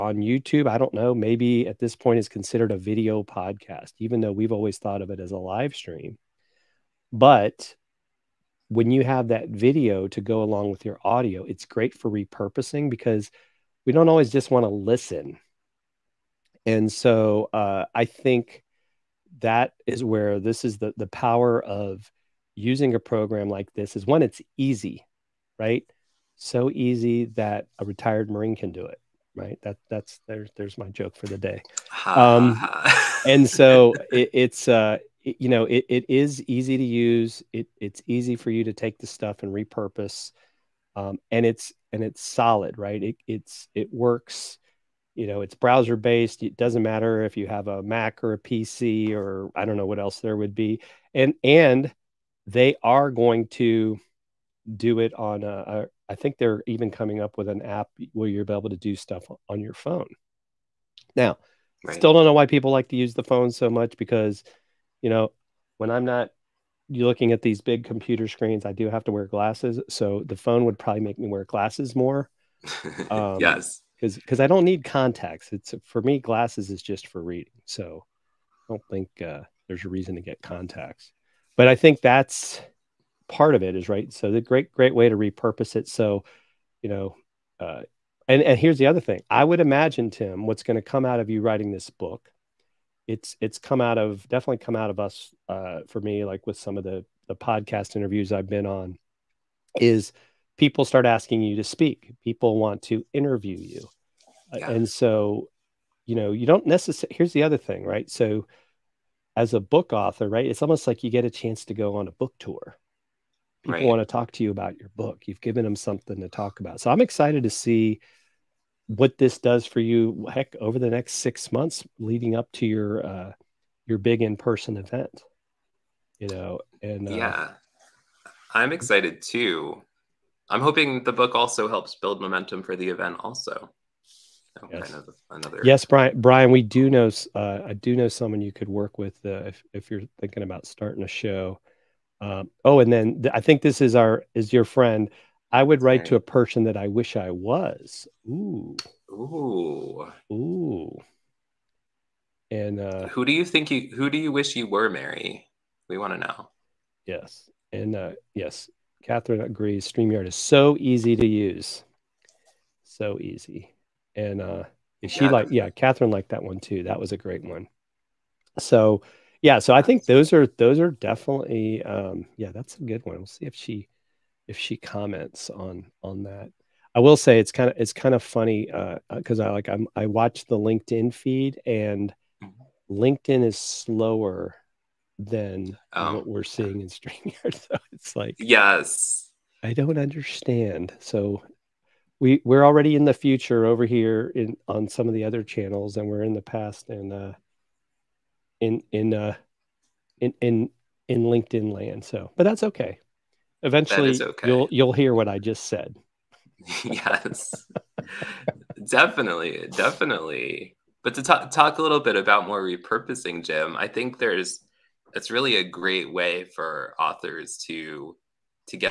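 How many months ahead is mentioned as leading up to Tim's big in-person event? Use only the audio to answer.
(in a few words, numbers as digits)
6.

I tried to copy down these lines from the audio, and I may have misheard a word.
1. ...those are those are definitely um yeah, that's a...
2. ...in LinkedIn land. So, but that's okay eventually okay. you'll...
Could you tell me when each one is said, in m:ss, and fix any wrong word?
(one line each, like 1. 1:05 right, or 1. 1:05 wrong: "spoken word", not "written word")
1. 2:50 right
2. 3:21 right.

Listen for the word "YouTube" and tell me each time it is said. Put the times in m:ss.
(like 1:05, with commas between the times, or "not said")
0:00.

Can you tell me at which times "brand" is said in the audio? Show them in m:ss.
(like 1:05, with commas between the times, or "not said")
not said.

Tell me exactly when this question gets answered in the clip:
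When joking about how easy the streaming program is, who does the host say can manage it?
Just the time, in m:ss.
0:27.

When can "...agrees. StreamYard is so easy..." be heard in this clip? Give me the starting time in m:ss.
2:39.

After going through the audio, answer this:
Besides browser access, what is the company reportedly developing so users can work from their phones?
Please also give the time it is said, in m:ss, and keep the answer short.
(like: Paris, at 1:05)
An app, at 0:57.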